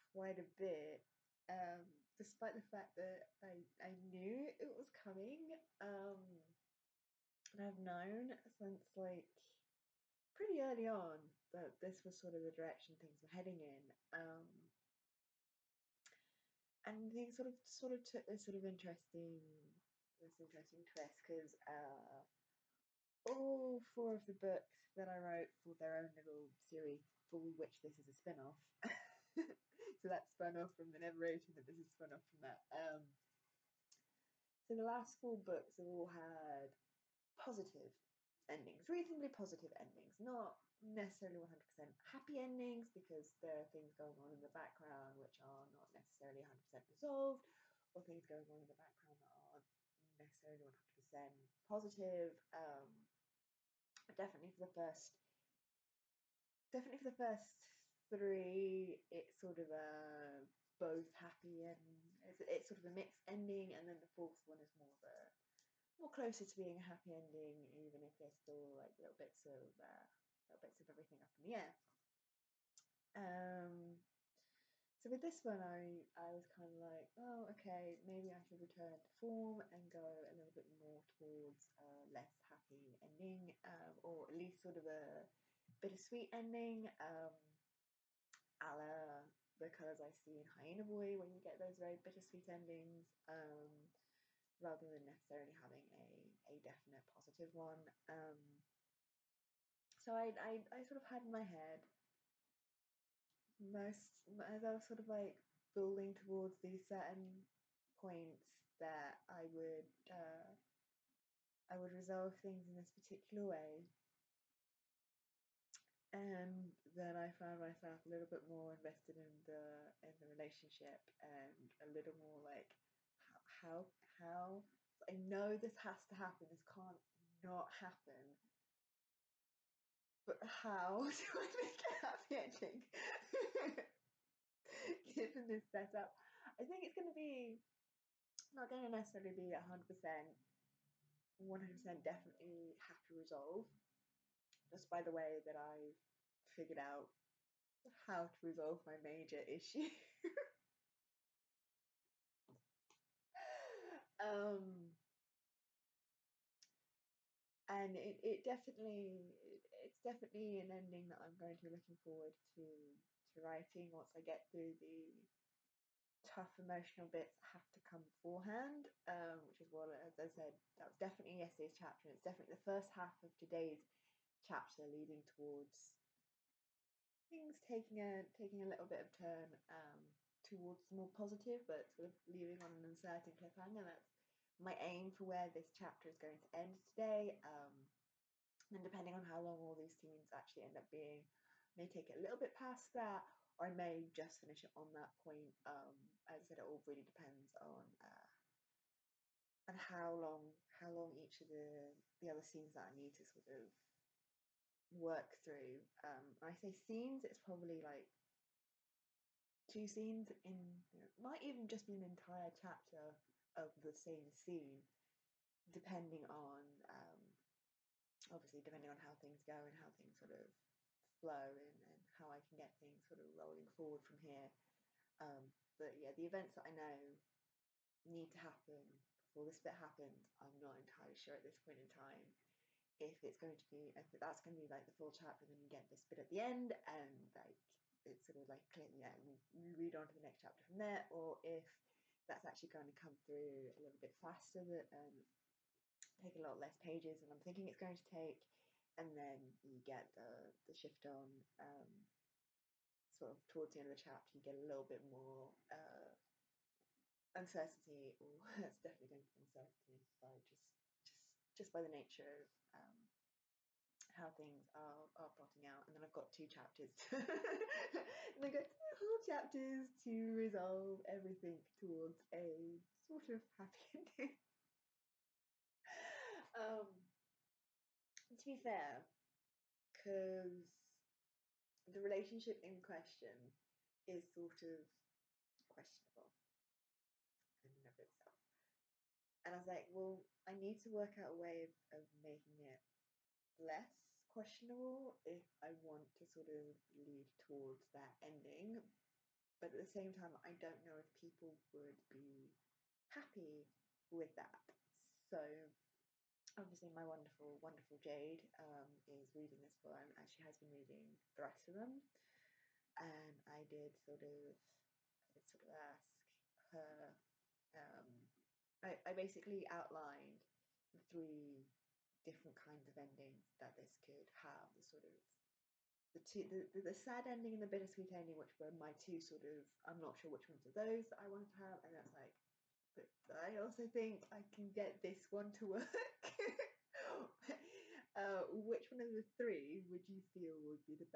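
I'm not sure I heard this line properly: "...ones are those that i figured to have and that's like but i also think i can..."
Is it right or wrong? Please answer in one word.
wrong.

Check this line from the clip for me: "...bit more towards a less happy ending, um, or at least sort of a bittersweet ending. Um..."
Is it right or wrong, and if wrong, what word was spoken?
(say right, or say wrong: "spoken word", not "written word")
right.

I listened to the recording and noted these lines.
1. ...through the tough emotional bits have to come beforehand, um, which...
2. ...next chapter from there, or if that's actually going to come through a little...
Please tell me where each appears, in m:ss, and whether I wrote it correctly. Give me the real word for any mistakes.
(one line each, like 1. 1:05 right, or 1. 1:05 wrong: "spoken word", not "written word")
1. 2:44 right
2. 4:00 right.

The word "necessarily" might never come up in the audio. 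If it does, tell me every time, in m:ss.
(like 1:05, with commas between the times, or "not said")
0:40, 0:45, 0:50, 1:35, 2:18.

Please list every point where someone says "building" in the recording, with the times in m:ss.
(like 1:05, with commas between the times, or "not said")
1:45.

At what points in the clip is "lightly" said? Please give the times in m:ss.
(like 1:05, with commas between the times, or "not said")
not said.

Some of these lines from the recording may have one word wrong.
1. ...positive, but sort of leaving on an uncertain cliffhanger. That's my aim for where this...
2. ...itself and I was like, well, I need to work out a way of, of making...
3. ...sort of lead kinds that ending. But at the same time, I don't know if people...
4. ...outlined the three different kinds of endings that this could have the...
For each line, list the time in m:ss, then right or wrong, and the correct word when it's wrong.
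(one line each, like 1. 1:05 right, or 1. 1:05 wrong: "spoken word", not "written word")
1. 3:01 right
2. 4:47 right
3. 4:56 wrong: "towards", not "kinds"
4. 5:19 right.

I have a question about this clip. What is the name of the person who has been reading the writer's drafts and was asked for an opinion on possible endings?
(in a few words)
Jade.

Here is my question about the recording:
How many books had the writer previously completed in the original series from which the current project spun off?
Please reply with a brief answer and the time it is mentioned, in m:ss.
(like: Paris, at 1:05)
4, at 0:23.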